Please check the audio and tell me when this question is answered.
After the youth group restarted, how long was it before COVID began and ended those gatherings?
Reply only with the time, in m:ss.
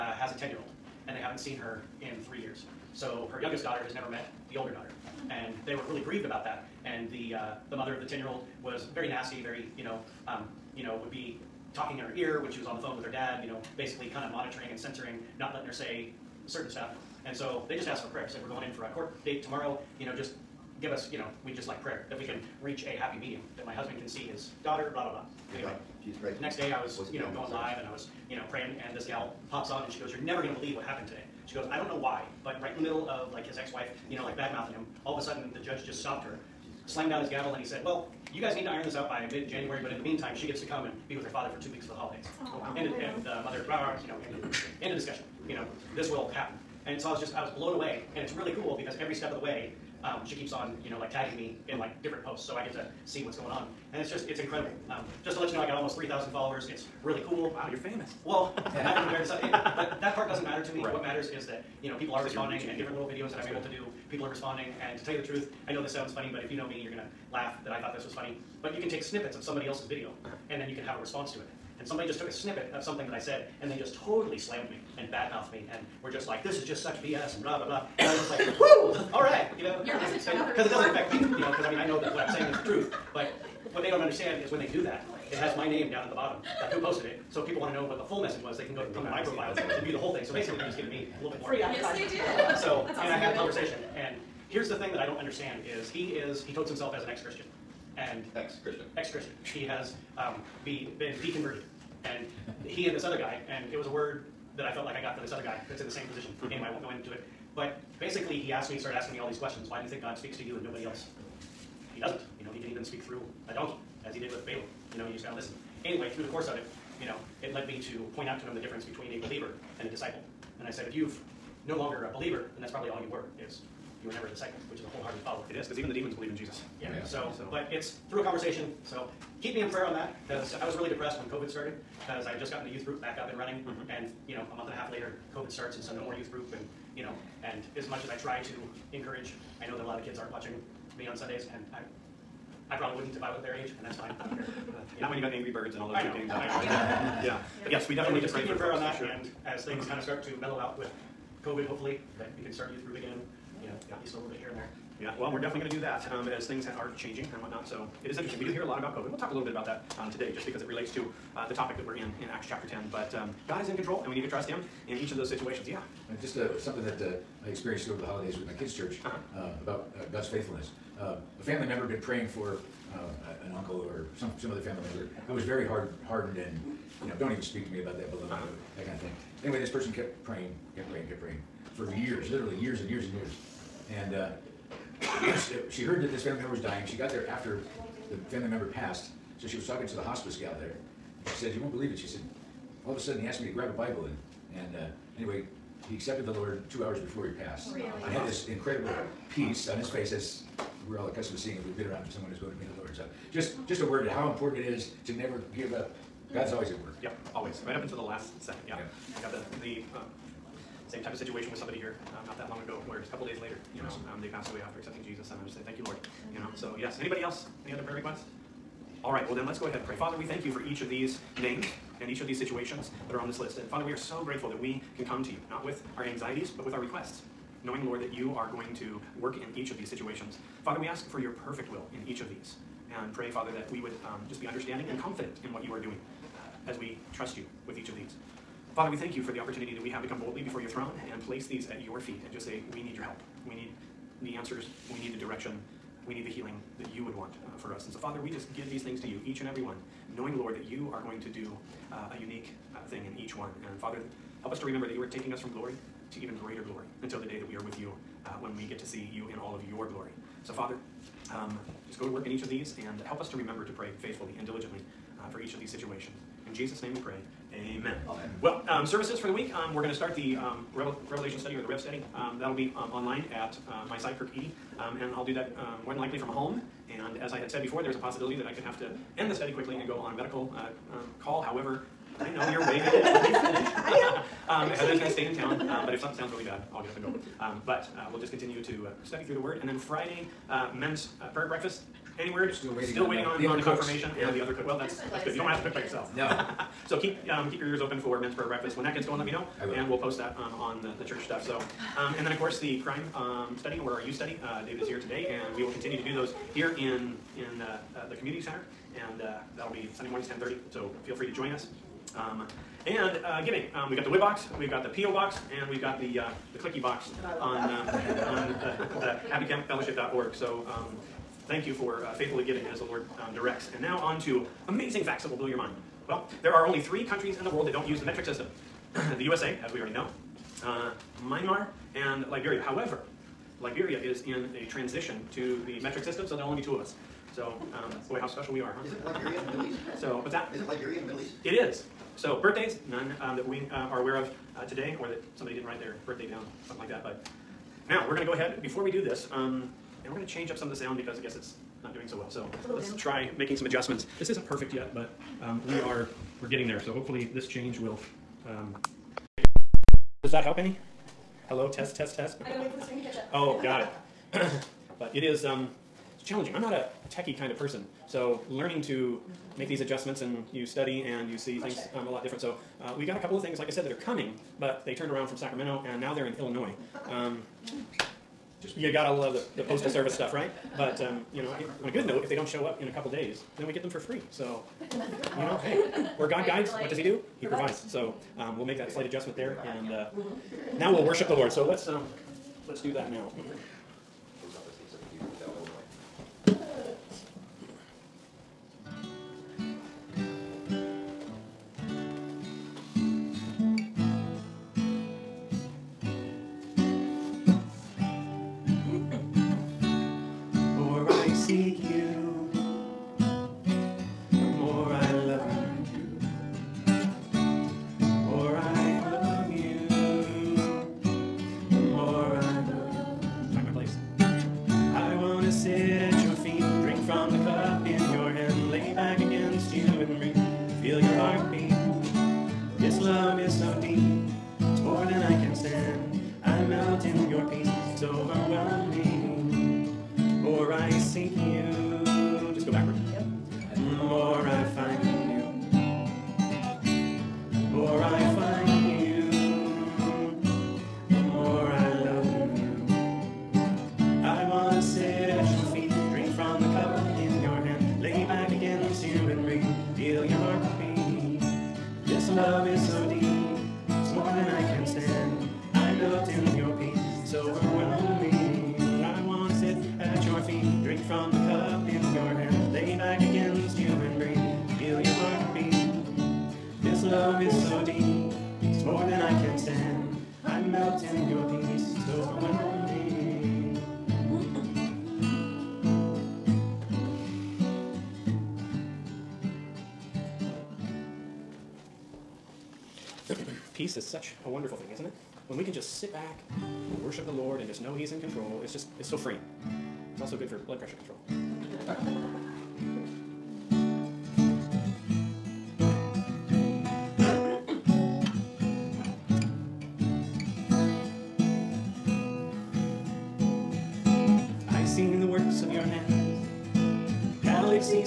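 2:14.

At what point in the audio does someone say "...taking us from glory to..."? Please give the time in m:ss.
4:15.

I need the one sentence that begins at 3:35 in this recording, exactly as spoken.
And I just said, thank you, Lord.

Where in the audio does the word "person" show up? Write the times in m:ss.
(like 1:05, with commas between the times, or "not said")
2:59, 6:07.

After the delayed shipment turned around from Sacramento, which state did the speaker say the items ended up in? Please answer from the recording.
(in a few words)
Illinois.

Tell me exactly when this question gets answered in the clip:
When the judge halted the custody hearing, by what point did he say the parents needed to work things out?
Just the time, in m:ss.
0:39.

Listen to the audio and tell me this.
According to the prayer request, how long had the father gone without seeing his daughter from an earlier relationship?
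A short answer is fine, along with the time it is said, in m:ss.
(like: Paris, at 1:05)
3 years, at 0:02.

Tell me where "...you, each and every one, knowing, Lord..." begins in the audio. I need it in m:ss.
4:09.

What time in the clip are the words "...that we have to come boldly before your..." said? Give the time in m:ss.
3:59.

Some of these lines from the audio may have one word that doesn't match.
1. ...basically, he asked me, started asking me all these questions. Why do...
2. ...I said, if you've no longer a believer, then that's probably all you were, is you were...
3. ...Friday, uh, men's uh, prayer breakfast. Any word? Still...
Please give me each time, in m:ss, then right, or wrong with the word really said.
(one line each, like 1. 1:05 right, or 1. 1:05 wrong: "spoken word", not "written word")
1. 1:47 right
2. 2:00 right
3. 4:49 right.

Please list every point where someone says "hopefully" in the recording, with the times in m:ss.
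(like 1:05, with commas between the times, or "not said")
2:31, 5:56.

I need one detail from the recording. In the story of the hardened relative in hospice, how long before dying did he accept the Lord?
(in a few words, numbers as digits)
2 hours.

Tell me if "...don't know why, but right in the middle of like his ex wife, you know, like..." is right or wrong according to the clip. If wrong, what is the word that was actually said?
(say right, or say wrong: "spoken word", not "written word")
right.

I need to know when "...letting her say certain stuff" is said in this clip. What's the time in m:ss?
0:15.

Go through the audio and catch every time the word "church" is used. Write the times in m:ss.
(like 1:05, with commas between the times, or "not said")
2:48, 5:01.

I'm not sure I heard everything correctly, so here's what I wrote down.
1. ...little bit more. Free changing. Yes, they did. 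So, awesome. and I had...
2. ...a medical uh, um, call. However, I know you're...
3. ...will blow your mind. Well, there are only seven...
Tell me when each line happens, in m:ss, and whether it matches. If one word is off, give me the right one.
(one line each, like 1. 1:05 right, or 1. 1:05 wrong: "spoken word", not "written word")
1. 1:31 wrong: "advertising", not "changing"
2. 4:40 right
3. 5:25 wrong: "three", not "seven".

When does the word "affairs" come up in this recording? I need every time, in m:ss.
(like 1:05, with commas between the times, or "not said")
not said.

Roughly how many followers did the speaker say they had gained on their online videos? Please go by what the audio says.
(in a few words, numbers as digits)
3,000.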